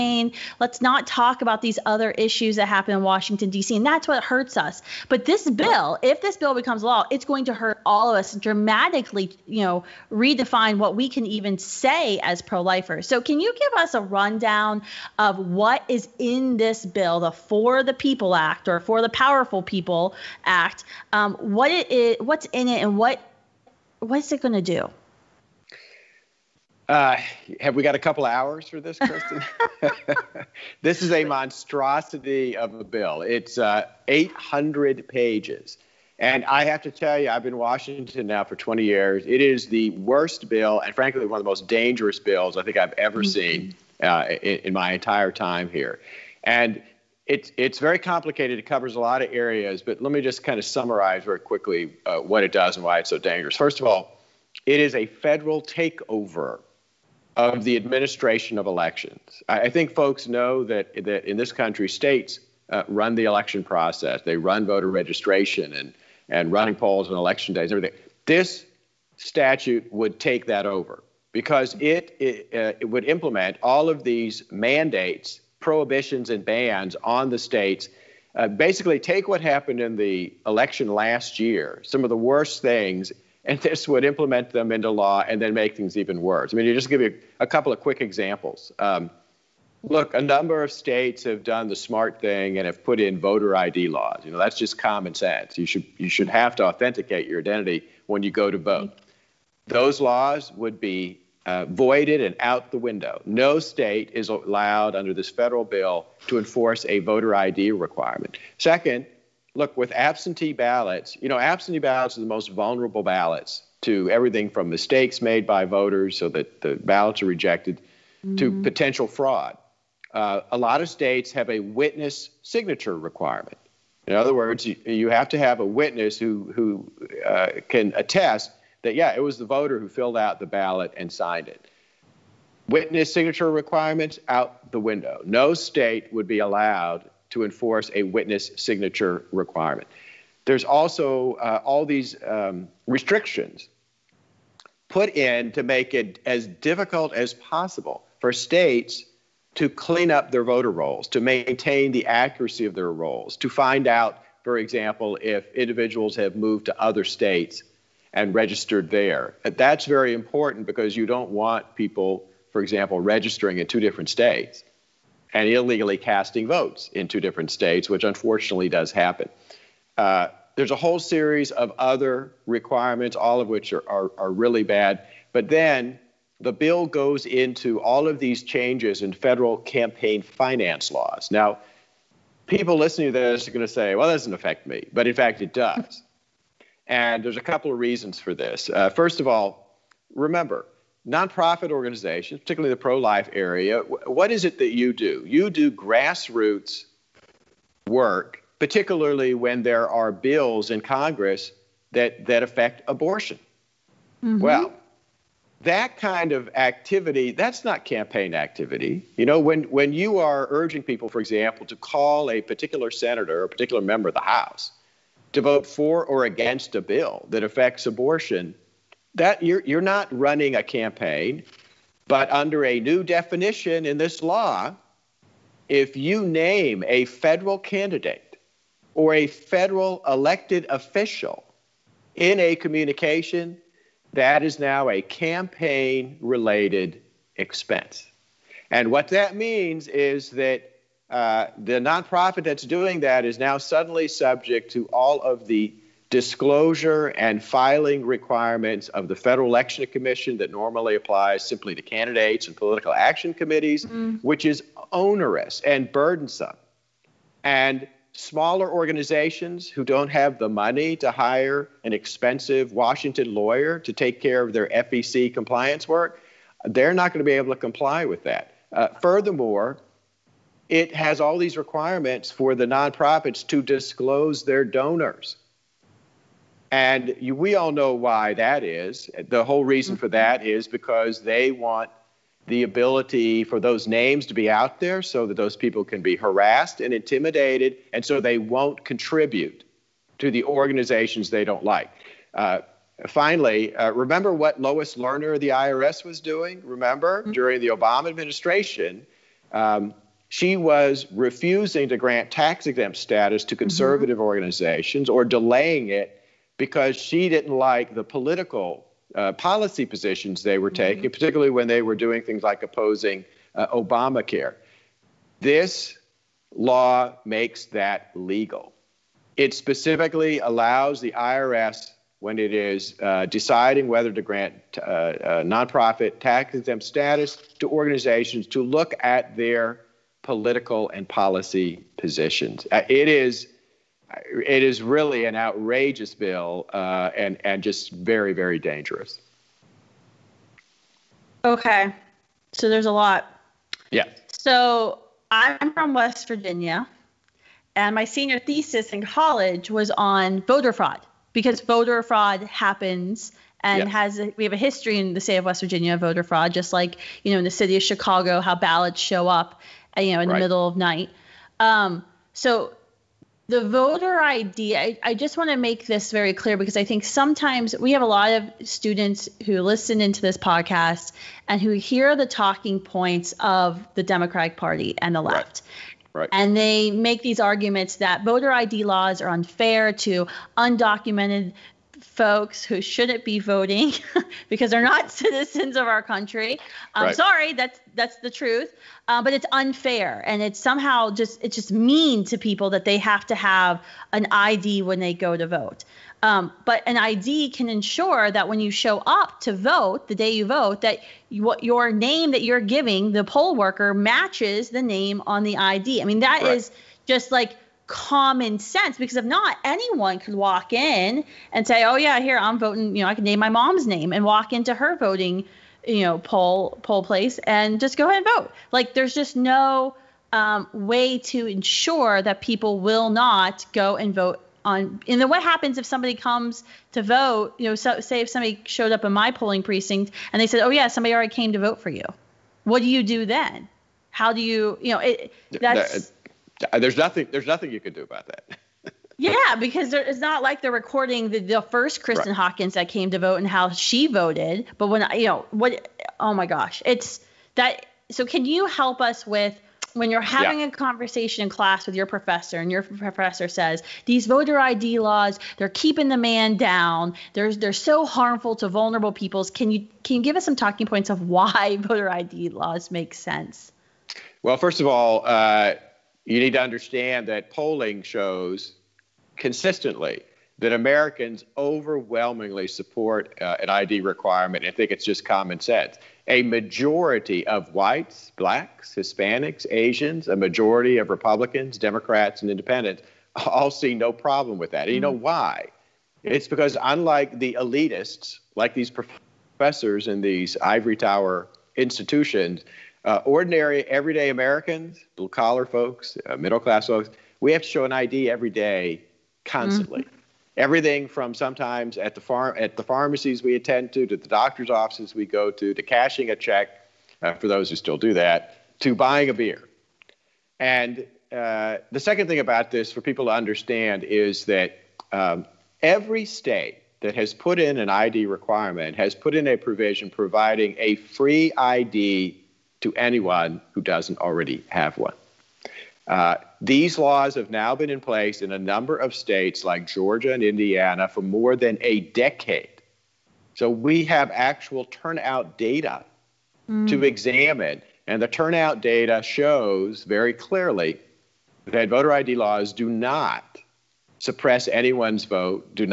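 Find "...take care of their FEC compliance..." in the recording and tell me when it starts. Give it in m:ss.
4:23.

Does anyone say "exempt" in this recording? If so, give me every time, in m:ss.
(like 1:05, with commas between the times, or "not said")
5:02, 5:26.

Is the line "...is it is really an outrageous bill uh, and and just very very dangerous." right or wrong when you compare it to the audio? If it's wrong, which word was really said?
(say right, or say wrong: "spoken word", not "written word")
right.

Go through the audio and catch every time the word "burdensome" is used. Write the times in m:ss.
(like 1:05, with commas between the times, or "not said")
4:15.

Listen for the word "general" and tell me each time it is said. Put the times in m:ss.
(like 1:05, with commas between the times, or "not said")
not said.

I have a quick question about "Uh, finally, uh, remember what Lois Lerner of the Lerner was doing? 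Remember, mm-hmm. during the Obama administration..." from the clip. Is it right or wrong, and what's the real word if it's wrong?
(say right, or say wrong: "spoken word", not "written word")
wrong: "IRS", not "Lerner".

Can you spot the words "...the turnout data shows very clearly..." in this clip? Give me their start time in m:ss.
8:58.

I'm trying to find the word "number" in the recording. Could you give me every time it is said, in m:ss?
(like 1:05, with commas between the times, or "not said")
1:30, 8:48.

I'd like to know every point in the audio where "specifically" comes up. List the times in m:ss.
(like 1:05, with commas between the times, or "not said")
5:19.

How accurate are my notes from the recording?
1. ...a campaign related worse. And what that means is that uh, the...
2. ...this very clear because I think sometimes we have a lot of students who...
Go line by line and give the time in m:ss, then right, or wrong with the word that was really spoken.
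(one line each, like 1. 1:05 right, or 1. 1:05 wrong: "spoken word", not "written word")
1. 3:54 wrong: "expense", not "worse"
2. 6:05 right.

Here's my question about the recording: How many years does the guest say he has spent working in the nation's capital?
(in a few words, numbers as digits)
20.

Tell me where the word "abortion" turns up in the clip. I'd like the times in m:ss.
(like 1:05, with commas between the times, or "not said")
3:22, 3:37.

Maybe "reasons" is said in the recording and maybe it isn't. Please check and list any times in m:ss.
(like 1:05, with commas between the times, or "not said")
3:07, 4:39.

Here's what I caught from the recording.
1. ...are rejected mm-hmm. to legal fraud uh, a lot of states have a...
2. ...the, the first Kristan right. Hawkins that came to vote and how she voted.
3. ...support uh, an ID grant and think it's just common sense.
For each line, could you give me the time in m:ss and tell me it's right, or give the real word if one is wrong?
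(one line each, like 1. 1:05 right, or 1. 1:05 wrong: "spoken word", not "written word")
1. 1:57 wrong: "potential", not "legal"
2. 7:21 right
3. 7:52 wrong: "requirement", not "grant".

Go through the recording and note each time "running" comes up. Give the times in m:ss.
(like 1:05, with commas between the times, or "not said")
1:06, 3:40.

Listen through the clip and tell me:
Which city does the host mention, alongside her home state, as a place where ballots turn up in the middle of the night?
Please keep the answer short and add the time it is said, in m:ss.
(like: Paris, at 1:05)
Chicago, at 5:57.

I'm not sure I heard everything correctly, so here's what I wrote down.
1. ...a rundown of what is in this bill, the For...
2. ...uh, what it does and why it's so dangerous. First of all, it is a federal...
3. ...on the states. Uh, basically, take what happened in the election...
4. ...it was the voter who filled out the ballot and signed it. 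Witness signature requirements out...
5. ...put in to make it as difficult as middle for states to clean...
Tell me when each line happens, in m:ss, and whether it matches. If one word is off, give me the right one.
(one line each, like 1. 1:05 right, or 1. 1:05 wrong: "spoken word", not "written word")
1. 0:13 right
2. 0:52 right
3. 1:17 right
4. 2:09 right
5. 2:24 wrong: "possible", not "middle".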